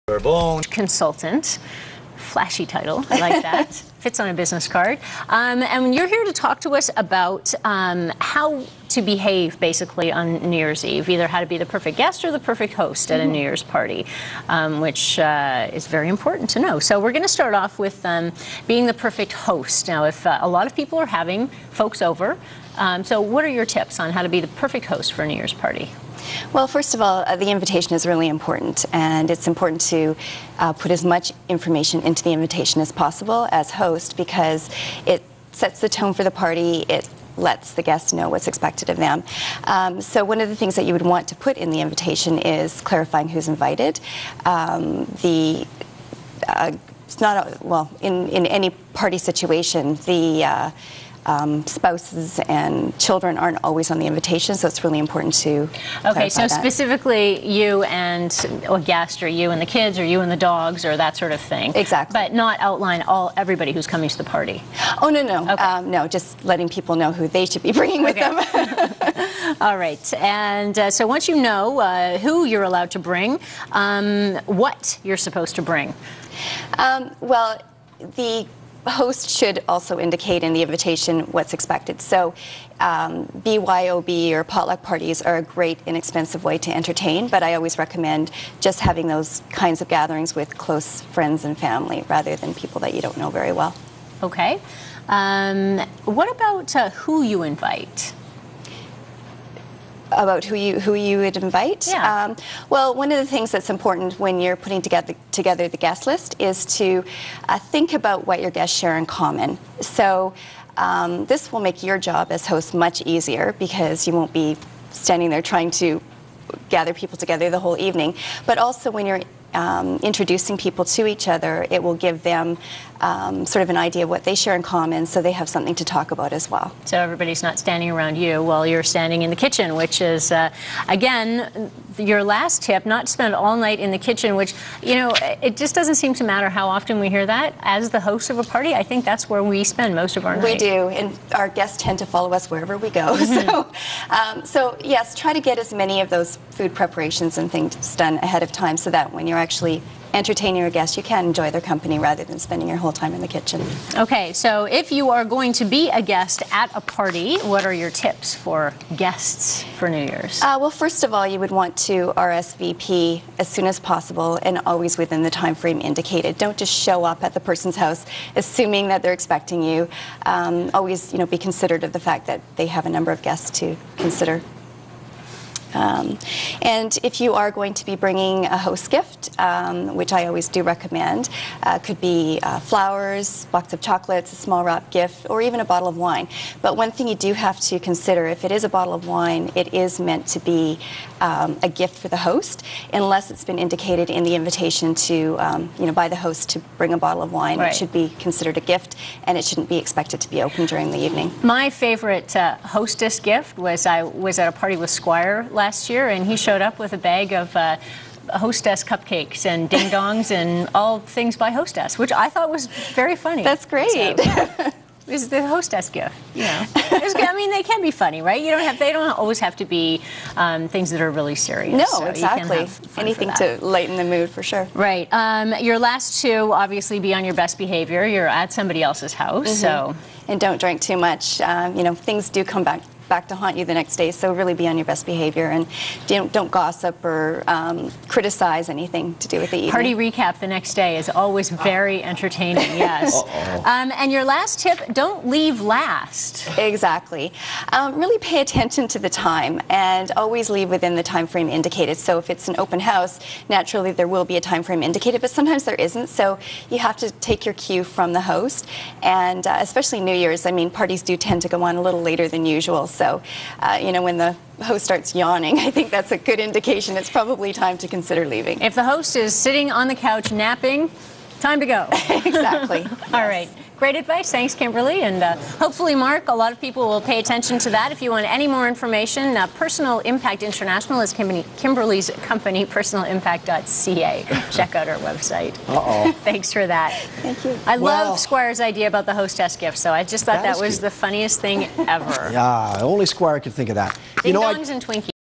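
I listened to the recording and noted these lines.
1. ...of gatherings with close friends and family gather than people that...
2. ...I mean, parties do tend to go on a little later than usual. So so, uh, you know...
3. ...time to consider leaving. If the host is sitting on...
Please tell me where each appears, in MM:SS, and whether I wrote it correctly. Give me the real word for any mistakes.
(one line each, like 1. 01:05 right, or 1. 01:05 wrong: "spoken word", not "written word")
1. 01:29 wrong: "rather", not "gather"
2. 04:20 right
3. 04:27 right.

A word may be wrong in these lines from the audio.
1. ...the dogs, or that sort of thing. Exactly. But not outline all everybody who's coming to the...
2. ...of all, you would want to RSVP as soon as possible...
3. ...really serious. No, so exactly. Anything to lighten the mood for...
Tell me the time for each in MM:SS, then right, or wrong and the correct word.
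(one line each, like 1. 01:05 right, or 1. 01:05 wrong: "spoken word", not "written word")
1. 01:00 right
2. 02:41 right
3. 03:41 right.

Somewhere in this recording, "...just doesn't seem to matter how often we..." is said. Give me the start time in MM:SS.
02:15.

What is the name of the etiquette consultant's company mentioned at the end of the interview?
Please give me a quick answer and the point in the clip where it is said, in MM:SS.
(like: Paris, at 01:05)
Personal Impact International, at 04:39.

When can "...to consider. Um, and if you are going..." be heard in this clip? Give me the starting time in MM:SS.
02:53.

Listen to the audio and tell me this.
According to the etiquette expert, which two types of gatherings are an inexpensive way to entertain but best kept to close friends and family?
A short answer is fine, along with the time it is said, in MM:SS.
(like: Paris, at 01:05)
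BYOB or potluck, at 01:23.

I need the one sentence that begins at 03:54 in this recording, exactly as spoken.
So really be on your best behavior and don't, don't gossip or um, criticize anything to do with the evening.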